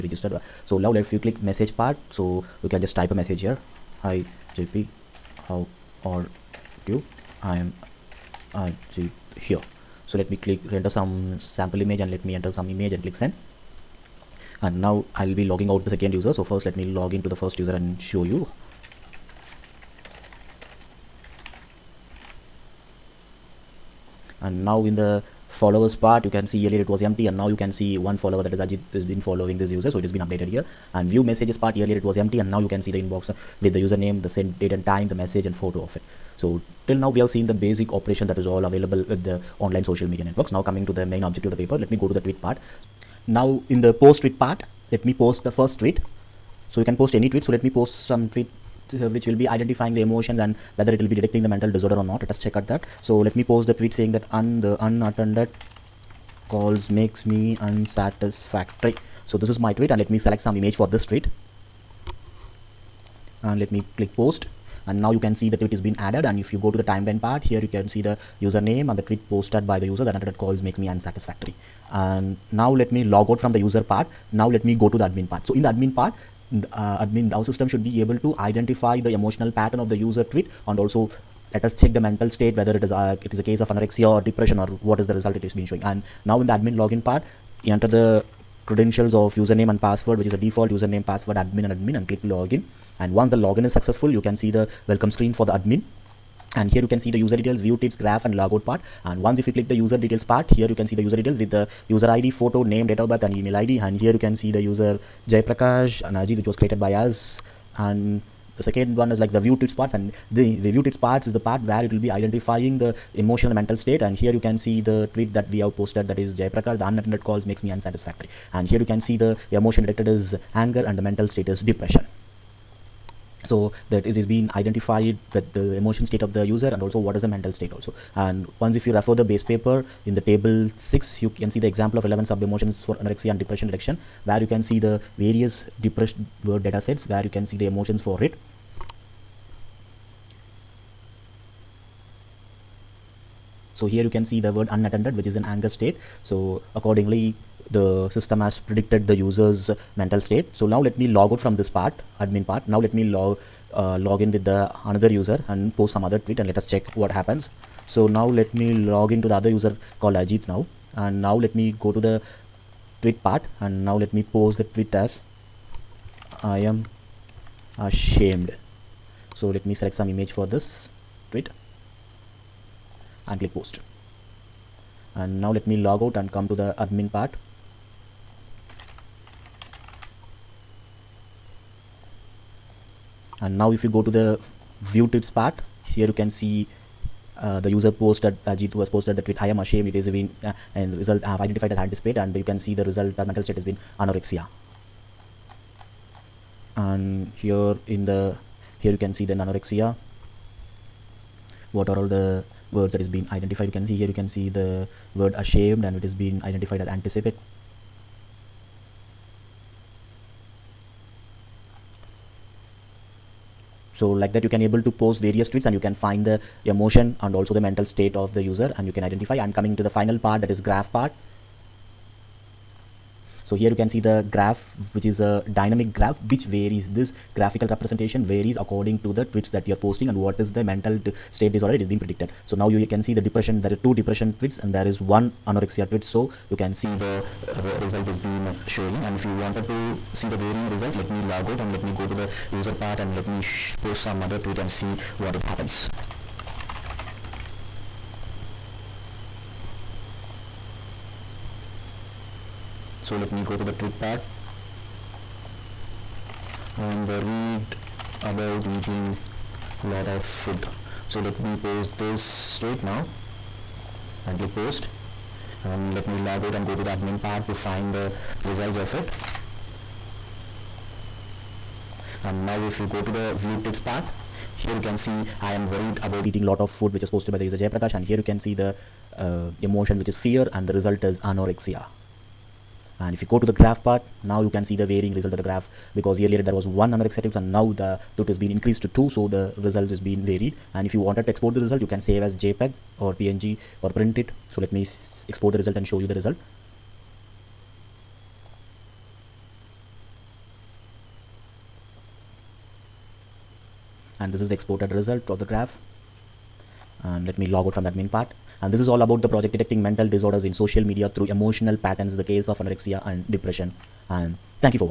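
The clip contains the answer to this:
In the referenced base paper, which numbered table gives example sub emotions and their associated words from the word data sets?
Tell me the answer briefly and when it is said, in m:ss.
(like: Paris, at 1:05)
Table 6, at 2:10.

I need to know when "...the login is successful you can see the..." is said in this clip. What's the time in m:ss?
1:33.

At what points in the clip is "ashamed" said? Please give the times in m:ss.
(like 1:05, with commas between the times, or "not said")
2:47, 3:09, 3:25.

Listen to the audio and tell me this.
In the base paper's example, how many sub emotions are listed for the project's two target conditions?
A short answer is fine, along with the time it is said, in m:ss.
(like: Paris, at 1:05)
11, at 2:12.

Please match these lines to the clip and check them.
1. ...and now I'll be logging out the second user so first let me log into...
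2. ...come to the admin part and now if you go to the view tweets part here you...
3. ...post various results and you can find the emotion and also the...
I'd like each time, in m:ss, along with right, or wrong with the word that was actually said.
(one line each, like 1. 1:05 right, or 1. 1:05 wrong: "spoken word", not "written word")
1. 0:14 right
2. 2:56 right
3. 3:34 wrong: "tweets", not "results".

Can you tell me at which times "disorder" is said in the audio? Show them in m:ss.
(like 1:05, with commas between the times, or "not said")
0:51, 3:51, 5:10.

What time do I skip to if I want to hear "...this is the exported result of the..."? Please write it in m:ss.
5:04.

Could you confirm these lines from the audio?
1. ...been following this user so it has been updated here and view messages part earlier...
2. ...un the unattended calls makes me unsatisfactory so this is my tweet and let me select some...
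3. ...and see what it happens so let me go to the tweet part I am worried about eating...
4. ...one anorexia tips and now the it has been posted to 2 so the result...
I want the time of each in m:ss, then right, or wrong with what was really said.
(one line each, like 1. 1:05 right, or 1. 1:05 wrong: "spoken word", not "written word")
1. 0:29 right
2. 0:54 right
3. 4:04 right
4. 4:46 wrong: "increased", not "posted".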